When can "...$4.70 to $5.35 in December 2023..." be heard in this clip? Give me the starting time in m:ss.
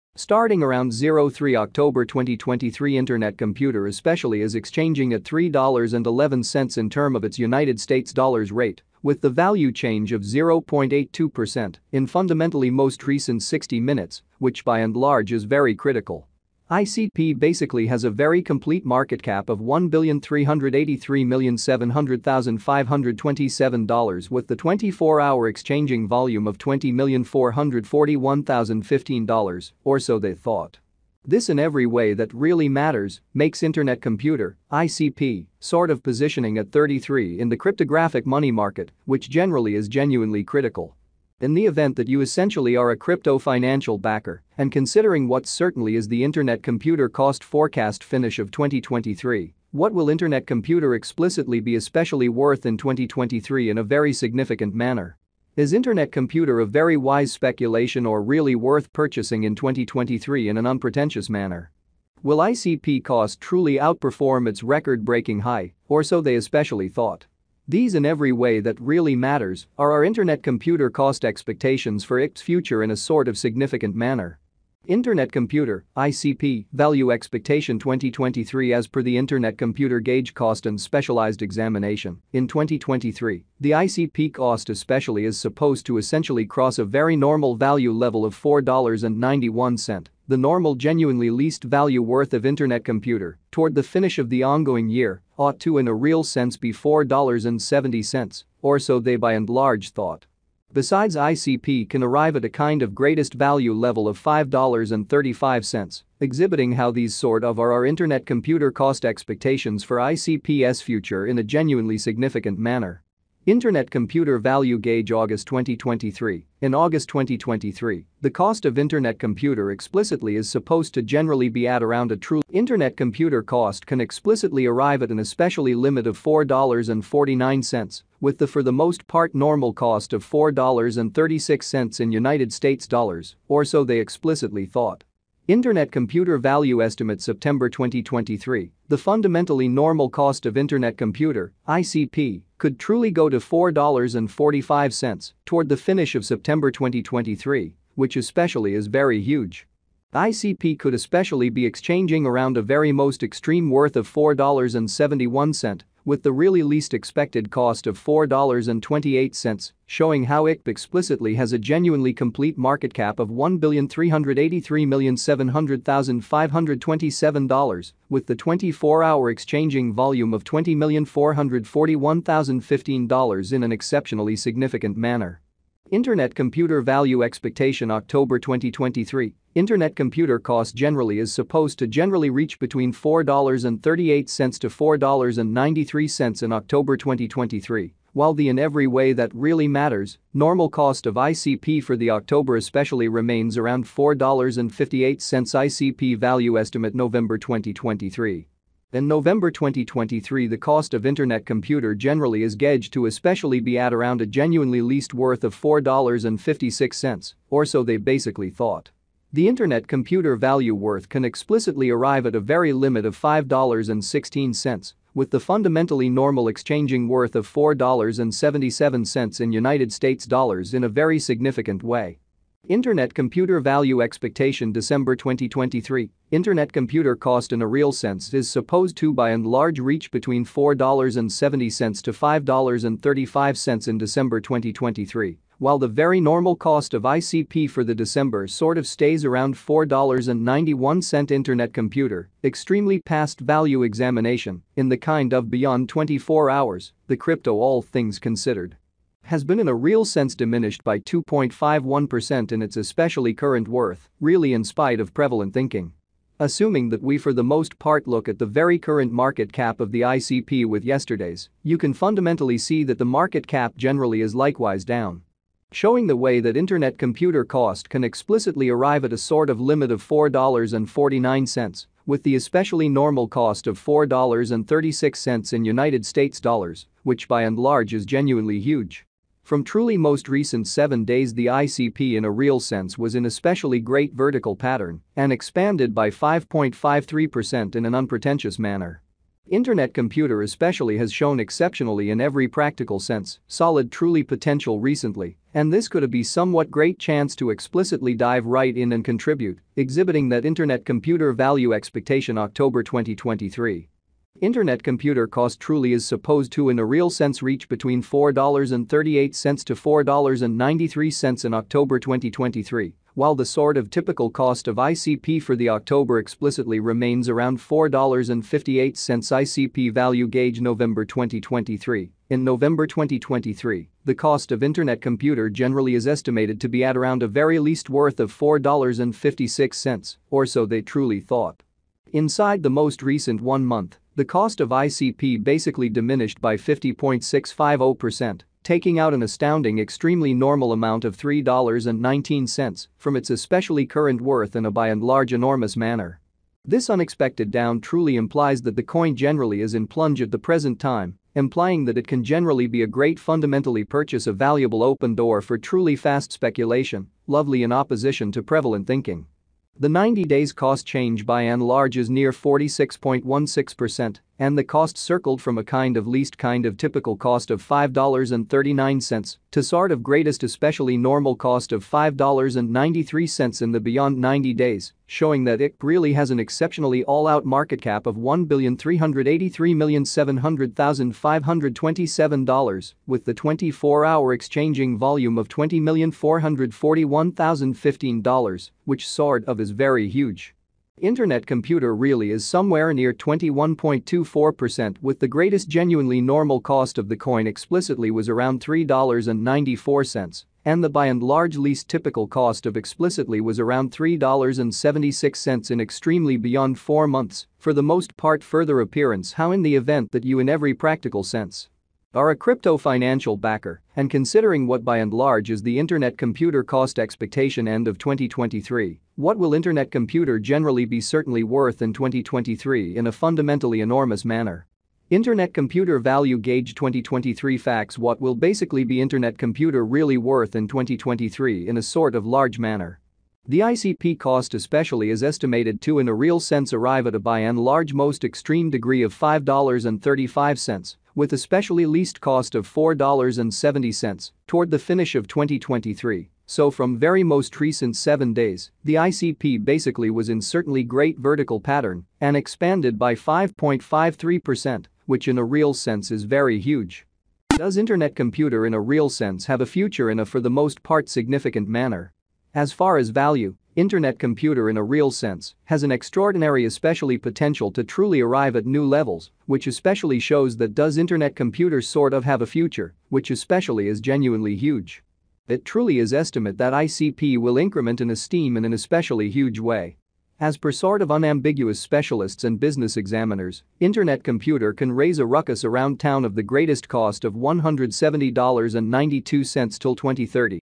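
3:50.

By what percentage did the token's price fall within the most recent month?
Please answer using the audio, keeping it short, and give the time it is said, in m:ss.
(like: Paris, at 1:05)
50.650%, at 5:36.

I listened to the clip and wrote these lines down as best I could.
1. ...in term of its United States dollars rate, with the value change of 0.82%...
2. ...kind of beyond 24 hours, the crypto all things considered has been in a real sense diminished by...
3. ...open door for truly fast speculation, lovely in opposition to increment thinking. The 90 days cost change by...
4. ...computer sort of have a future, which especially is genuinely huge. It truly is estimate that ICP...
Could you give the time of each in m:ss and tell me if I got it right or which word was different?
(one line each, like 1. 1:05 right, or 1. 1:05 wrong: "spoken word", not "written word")
1. 0:06 right
2. 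4:04 right
3. 5:54 wrong: "prevalent", not "increment"
4. 7:51 right.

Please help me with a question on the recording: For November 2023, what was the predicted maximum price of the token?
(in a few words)
$5.16.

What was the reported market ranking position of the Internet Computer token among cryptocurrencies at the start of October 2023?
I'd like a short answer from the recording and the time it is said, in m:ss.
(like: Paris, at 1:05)
33, at 0:36.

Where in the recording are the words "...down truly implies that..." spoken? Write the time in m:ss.
5:47.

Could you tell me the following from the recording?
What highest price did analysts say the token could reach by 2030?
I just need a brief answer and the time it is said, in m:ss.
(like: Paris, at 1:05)
$170.92, at 8:07.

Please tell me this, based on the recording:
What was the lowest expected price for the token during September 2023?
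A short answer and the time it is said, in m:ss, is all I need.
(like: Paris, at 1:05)
$4.28, at 2:38.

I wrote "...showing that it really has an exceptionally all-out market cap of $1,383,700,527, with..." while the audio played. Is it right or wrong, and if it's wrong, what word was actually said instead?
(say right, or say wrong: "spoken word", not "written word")
right.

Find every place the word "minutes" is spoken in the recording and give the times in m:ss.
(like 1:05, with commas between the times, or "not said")
0:13.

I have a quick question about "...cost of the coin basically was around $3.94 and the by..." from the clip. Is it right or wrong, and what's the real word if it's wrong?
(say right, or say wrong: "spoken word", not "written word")
wrong: "explicitly", not "basically".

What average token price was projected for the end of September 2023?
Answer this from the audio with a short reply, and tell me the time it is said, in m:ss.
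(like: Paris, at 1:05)
$4.45, at 2:23.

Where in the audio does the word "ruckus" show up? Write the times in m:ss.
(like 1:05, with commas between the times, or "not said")
8:05.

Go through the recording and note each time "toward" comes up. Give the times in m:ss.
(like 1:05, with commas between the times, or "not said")
1:33, 2:25, 7:24.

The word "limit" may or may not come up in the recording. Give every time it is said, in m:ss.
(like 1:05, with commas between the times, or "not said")
2:05, 3:32, 4:29.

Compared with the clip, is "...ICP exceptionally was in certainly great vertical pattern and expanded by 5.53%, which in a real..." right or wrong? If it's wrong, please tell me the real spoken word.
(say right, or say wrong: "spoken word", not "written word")
wrong: "basically", not "exceptionally".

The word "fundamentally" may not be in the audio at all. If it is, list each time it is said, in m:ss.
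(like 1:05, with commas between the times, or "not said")
0:12, 2:18, 3:35, 4:21, 5:53, 7:03.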